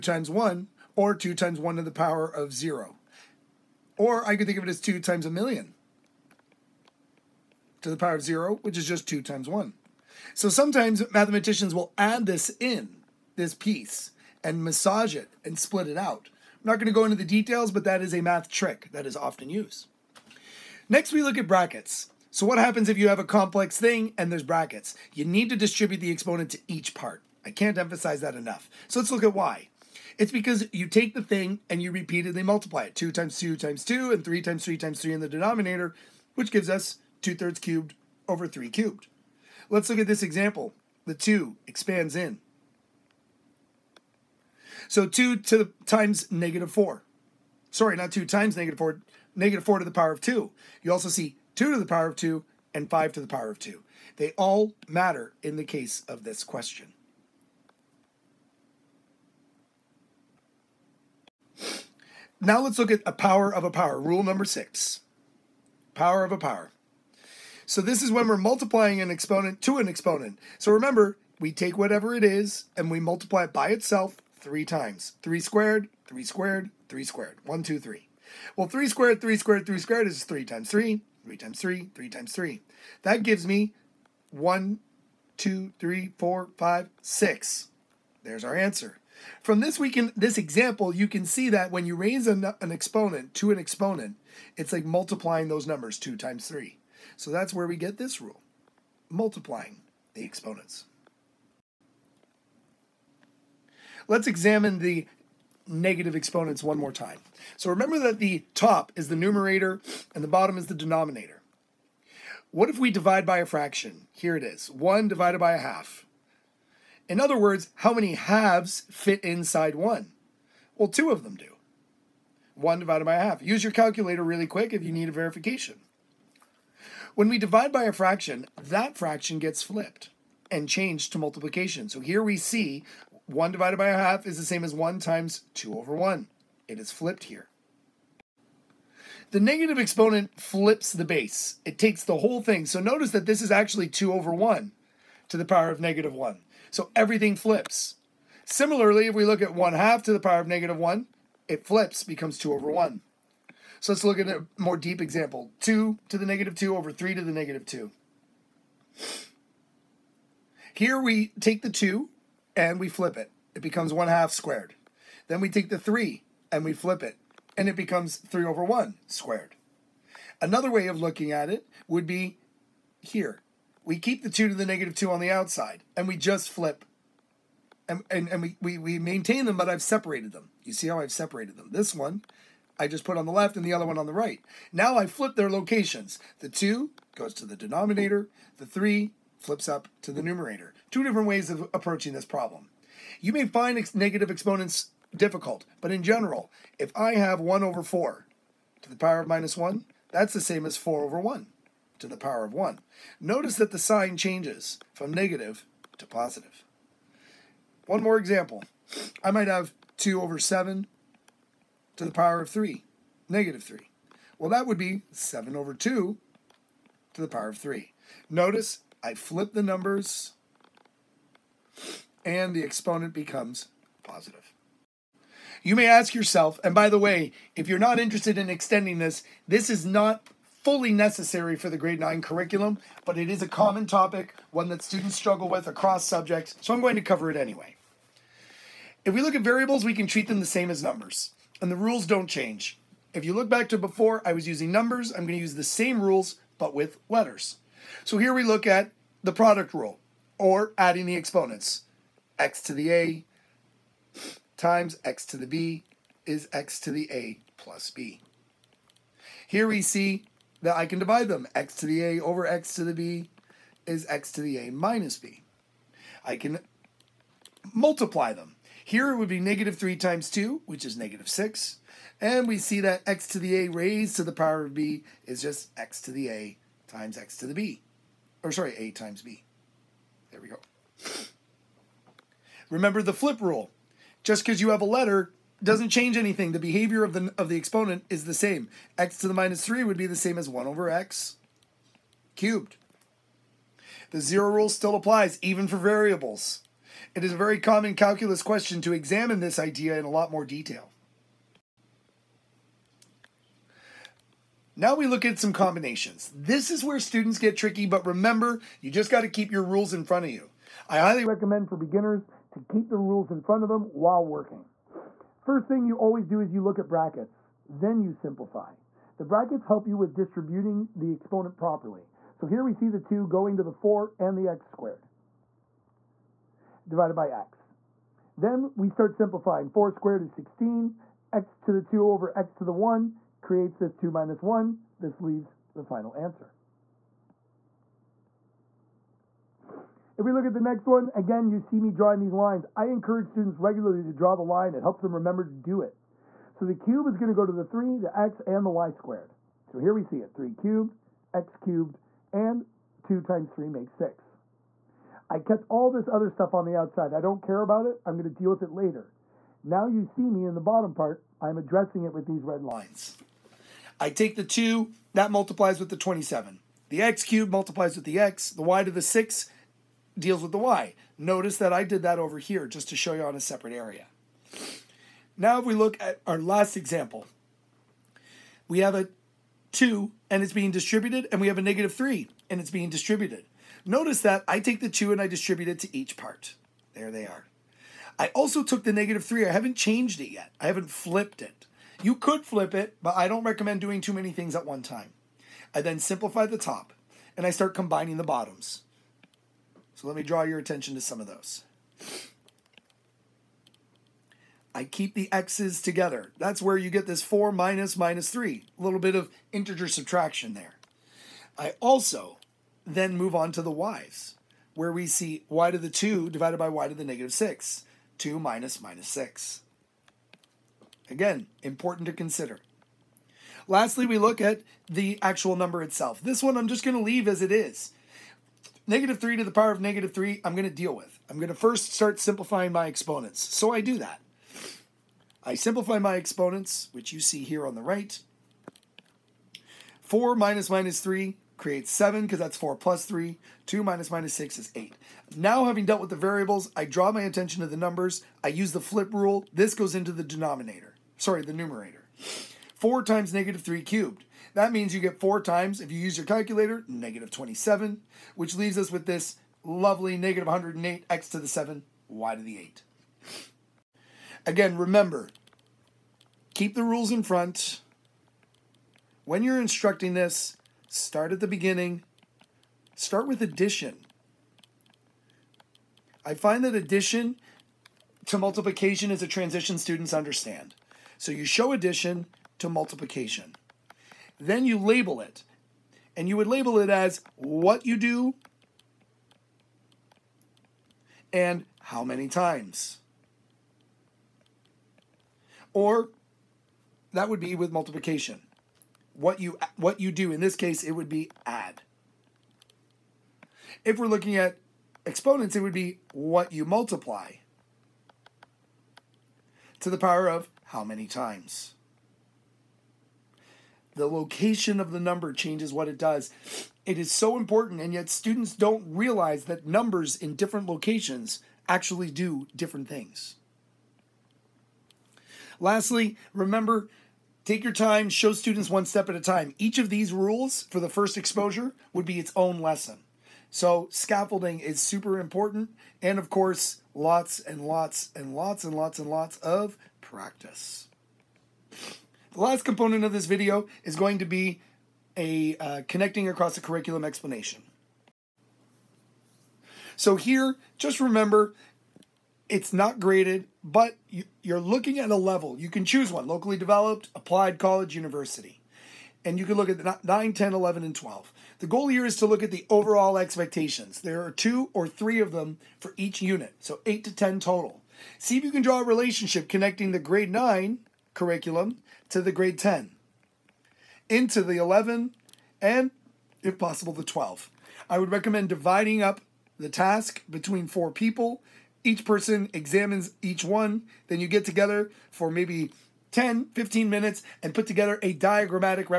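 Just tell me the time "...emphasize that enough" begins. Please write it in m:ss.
0:27.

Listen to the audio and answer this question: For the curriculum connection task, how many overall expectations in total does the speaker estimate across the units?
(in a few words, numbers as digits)
8 to 10.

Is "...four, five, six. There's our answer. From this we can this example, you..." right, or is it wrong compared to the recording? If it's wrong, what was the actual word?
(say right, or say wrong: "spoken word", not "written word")
right.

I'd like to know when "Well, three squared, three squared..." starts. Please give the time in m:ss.
1:18.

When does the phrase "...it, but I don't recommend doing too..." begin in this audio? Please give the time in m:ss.
6:32.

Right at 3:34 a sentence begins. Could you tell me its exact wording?
Well, that would be 7 over 2 to the power of 3.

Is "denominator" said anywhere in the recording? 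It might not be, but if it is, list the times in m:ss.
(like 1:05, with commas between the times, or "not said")
0:35, 1:50, 3:07, 7:30.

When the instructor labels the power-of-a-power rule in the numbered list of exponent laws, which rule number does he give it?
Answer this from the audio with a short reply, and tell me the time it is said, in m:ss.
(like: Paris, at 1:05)
6, at 1:04.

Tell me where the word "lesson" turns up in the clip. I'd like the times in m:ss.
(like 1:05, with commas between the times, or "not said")
8:52.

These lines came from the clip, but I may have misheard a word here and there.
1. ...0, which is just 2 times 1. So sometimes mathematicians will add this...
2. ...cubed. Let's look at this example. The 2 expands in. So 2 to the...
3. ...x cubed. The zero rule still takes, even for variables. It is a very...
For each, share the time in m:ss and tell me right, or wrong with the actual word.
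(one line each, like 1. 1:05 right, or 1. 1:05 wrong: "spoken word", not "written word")
1. 0:08 right
2. 0:38 right
3. 4:50 wrong: "applies", not "takes".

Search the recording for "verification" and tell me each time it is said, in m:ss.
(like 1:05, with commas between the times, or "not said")
2:05.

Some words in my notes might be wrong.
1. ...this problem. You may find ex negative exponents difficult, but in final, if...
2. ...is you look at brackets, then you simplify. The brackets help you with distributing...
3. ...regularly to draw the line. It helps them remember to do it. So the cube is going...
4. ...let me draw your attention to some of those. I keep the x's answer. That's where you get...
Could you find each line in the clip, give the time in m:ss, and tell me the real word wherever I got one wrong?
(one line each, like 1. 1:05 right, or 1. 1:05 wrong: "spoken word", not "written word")
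1. 3:12 wrong: "general", not "final"
2. 5:16 right
3. 5:43 right
4. 6:40 wrong: "together", not "answer".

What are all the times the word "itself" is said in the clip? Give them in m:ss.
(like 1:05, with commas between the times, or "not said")
1:13, 7:05.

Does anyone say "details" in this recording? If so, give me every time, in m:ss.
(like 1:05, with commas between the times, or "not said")
0:17, 5:00.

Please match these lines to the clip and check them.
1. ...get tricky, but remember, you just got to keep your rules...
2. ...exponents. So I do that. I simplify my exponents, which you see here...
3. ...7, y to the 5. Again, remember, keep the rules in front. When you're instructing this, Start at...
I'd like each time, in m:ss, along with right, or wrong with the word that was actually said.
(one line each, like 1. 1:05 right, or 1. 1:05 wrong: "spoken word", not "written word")
1. 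5:07 right
2. 7:12 right
3. 7:41 wrong: "8", not "5".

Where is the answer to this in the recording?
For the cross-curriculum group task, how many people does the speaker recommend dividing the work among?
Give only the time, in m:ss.
9:40.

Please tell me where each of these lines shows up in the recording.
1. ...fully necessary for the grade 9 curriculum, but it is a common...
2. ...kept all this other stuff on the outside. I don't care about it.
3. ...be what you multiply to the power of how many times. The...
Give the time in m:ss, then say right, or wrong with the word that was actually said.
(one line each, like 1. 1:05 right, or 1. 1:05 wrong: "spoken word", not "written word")
1. 3:50 right
2. 5:55 right
3. 8:25 right.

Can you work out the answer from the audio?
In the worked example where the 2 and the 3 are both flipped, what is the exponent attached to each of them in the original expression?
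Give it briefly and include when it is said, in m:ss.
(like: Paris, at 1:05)
negative 2, at 2:35.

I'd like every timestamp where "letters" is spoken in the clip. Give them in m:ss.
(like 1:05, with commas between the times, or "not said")
4:07, 4:44.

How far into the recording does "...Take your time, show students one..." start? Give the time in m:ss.
8:47.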